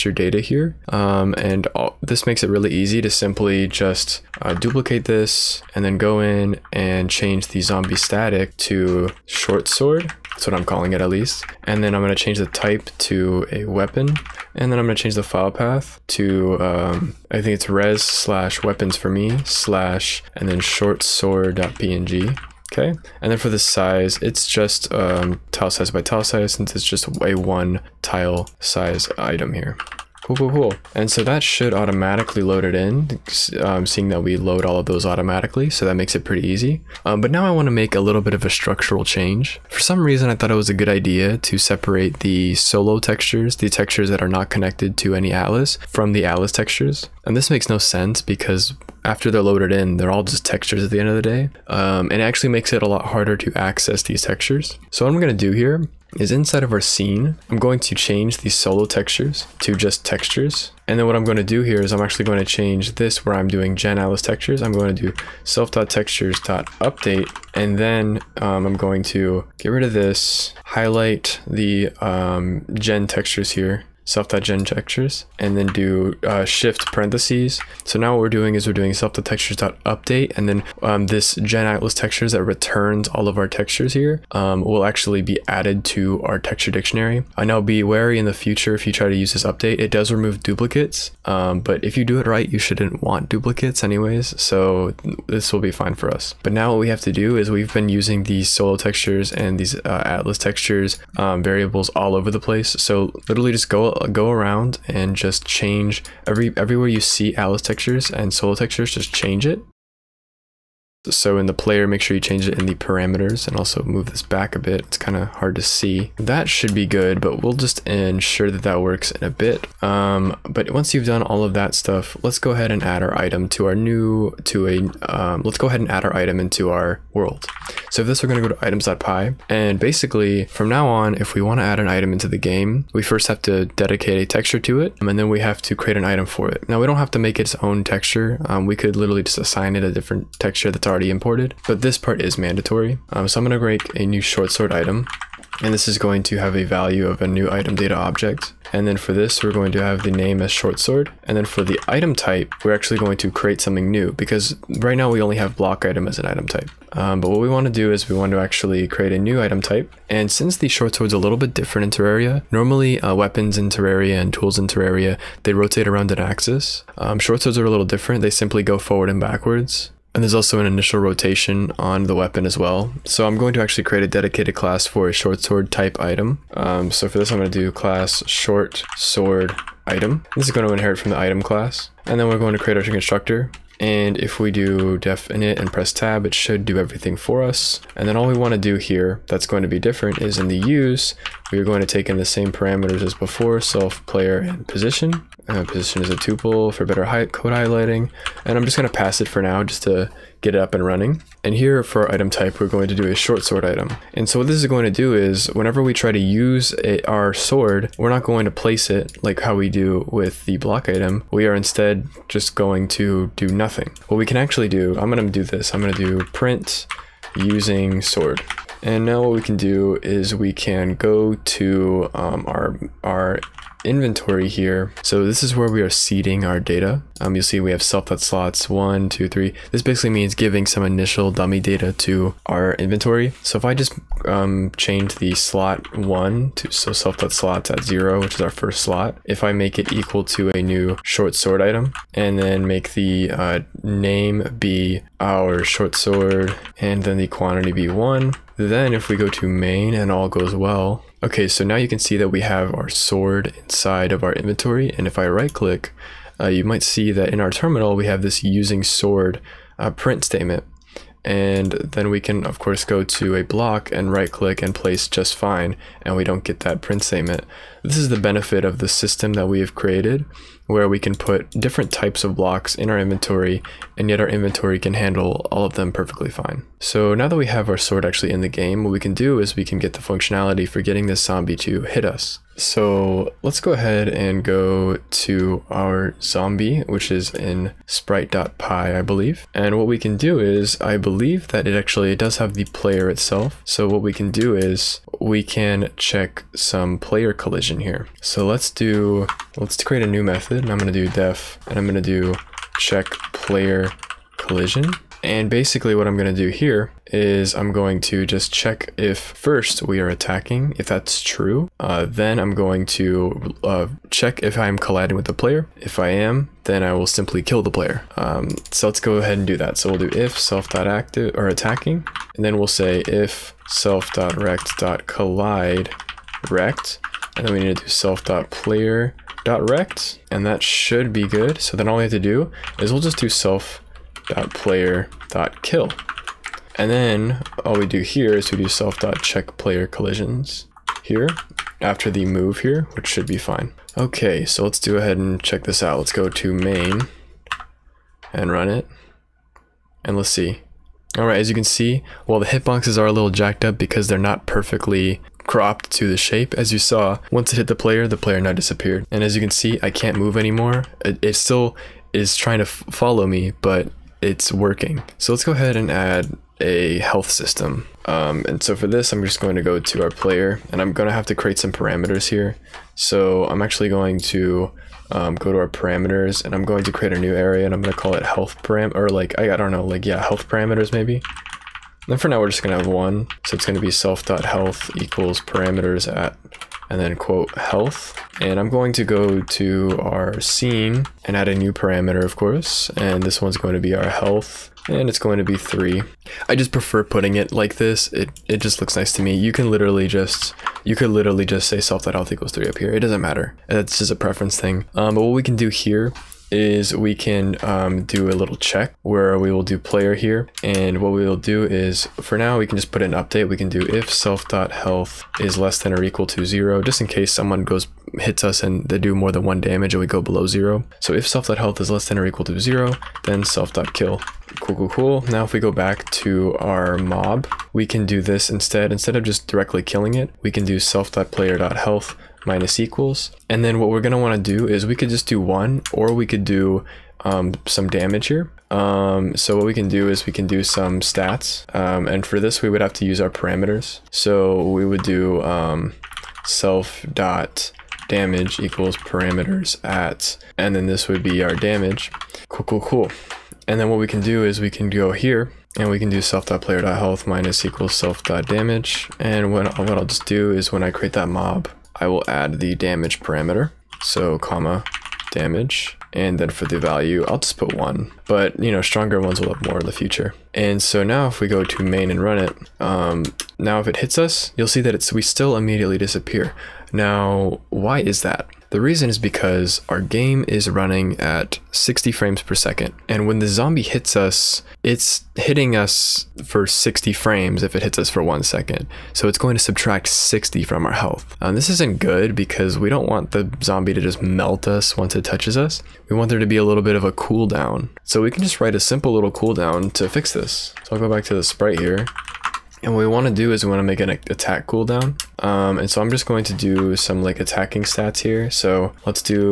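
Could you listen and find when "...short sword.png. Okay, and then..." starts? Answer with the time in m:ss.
0:20.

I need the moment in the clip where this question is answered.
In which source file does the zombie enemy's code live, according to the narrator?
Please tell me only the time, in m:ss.
4:47.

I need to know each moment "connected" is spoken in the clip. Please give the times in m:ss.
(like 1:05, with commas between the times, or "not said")
0:44.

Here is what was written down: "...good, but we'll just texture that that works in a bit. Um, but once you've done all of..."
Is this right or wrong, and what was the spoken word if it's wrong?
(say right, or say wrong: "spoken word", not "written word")
wrong: "ensure", not "texture".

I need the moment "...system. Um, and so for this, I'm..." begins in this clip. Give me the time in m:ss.
6:07.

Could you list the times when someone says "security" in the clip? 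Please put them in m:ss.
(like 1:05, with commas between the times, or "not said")
not said.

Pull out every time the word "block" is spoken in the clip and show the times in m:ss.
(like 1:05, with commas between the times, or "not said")
2:35, 3:30, 4:23, 4:32.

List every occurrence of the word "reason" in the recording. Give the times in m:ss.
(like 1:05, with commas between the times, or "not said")
0:40, 7:58.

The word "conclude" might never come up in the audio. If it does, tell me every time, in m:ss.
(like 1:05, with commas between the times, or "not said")
not said.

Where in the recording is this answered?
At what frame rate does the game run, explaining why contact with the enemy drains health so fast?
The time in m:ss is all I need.
8:01.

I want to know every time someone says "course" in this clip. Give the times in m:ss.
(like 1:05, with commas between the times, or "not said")
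4:22, 6:32.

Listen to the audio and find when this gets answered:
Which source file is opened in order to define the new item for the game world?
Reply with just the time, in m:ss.
2:08.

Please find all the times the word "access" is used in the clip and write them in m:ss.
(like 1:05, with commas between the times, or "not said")
0:53.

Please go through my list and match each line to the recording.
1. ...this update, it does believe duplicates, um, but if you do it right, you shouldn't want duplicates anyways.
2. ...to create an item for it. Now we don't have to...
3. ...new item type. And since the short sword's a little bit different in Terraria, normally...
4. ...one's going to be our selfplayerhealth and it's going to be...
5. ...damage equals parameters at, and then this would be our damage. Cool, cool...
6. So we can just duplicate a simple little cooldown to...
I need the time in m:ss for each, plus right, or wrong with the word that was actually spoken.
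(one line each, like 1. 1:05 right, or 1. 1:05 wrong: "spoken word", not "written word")
1. 1:29 wrong: "remove", not "believe"
2. 2:15 right
3. 2:39 right
4. 6:33 wrong: "health", not "selfplayerhealth"
5. 7:28 right
6. 8:18 wrong: "write", not "duplicate".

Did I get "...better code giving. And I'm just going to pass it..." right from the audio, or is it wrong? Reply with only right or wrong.
wrong.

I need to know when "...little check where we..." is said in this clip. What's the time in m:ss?
6:48.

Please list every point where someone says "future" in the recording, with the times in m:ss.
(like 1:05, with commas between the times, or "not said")
1:28, 7:49.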